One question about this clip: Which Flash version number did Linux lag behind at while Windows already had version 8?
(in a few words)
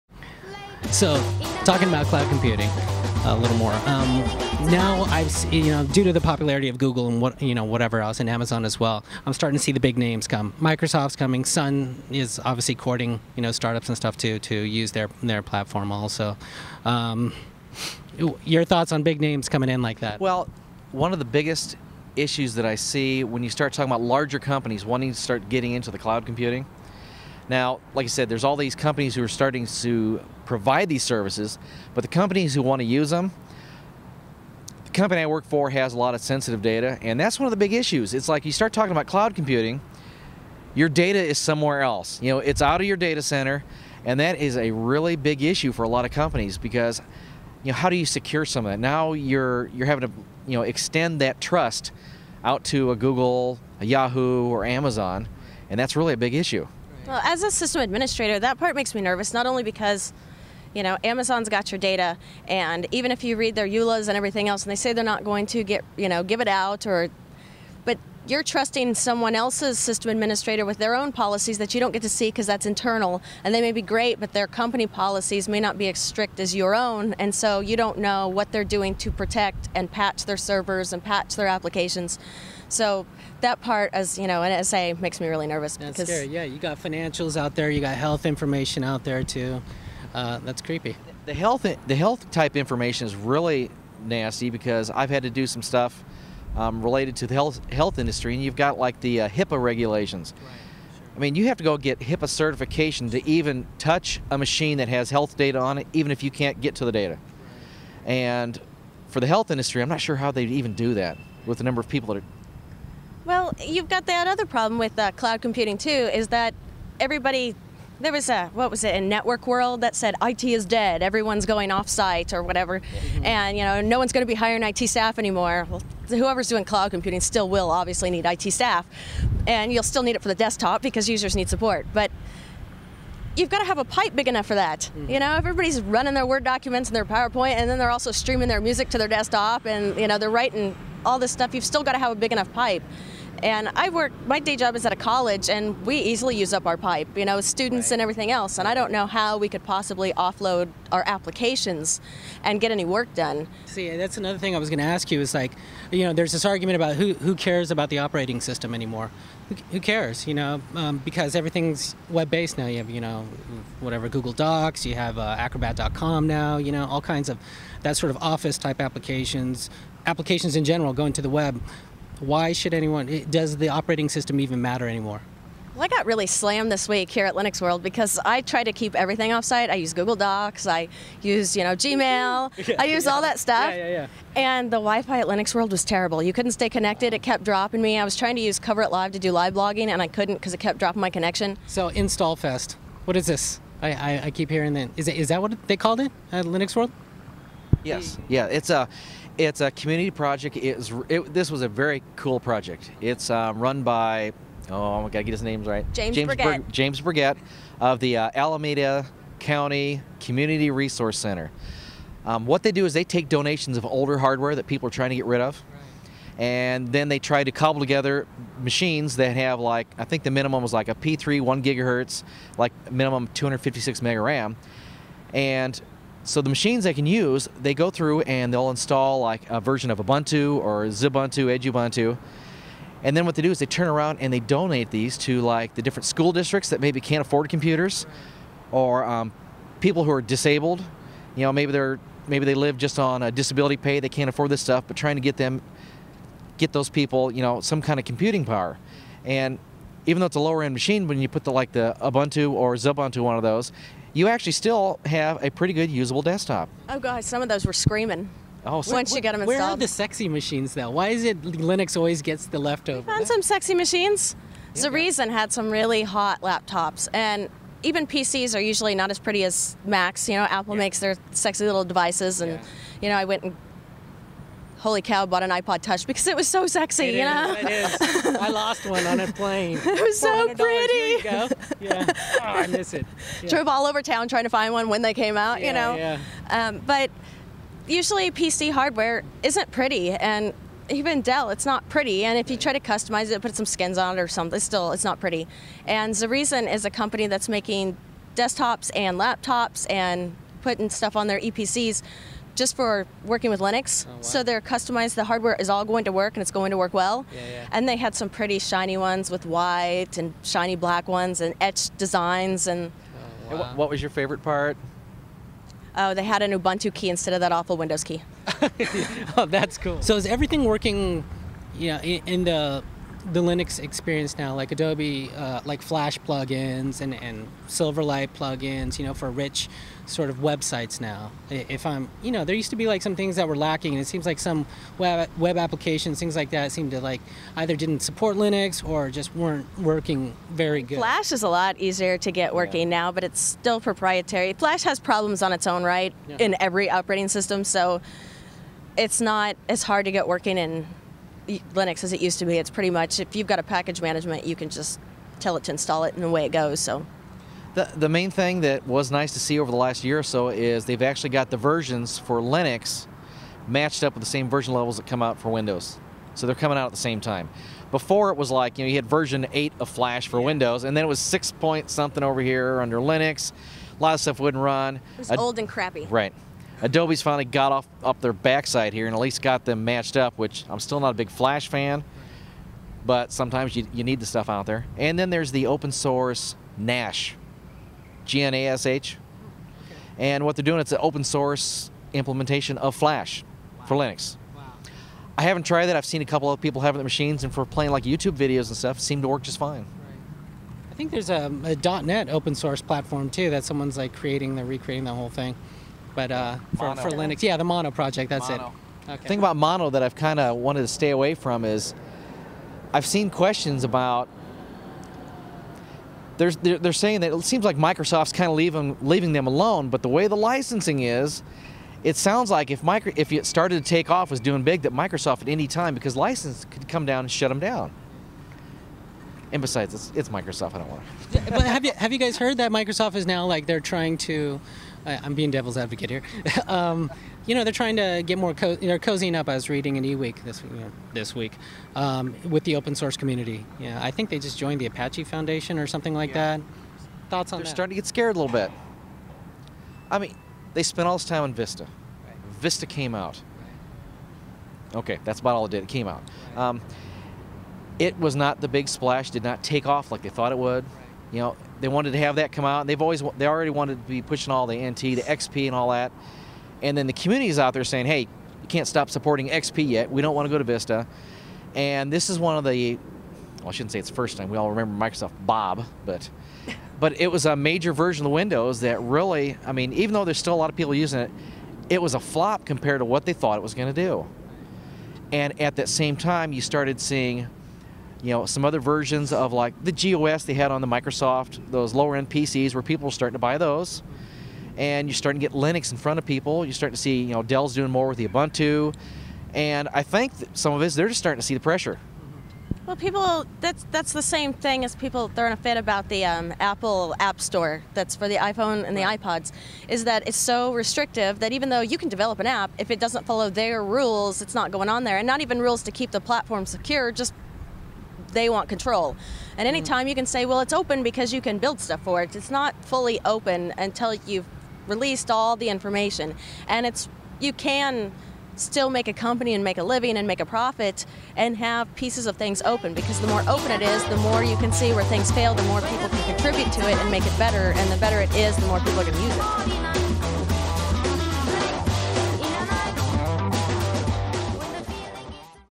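6.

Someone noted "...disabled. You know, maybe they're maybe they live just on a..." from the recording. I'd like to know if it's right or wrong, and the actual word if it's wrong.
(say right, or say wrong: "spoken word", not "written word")
right.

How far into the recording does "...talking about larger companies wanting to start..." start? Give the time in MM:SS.
00:23.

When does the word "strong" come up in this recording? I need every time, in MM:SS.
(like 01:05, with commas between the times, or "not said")
not said.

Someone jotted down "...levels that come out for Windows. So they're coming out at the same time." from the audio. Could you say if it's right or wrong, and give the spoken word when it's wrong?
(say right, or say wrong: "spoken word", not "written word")
right.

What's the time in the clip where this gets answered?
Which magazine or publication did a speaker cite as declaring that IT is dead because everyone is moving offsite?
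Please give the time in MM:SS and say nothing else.
01:59.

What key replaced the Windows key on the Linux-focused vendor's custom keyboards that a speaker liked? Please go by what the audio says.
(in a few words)
Ubuntu key.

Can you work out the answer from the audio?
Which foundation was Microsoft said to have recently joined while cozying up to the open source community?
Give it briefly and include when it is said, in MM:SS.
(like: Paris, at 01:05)
Apache Foundation, at 07:24.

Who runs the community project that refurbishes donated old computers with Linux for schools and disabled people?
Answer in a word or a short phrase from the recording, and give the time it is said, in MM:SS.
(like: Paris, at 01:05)
James Burgett, at 03:26.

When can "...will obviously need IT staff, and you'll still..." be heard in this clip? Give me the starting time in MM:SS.
02:07.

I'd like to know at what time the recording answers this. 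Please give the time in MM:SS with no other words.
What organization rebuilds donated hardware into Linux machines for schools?
03:28.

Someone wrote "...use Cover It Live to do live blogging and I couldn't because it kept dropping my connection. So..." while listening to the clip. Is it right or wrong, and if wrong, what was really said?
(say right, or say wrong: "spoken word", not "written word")
right.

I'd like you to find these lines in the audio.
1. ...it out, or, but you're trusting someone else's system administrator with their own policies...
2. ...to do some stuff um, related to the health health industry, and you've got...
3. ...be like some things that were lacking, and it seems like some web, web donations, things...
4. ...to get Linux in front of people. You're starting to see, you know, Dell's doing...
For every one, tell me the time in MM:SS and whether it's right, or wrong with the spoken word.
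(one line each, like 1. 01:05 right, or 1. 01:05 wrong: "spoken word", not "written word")
1. 01:06 right
2. 01:35 right
3. 05:32 wrong: "applications", not "donations"
4. 08:15 right.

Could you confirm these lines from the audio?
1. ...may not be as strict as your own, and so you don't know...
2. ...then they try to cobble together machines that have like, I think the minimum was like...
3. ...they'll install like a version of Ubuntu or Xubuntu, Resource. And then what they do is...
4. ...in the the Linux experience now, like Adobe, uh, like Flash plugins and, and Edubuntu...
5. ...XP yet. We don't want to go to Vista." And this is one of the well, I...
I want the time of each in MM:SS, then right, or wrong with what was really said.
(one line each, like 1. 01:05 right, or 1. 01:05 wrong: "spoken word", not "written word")
1. 01:15 right
2. 03:36 right
3. 03:48 wrong: "Edubuntu", not "Resource"
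4. 05:22 wrong: "Silverlight", not "Edubuntu"
5. 07:49 right.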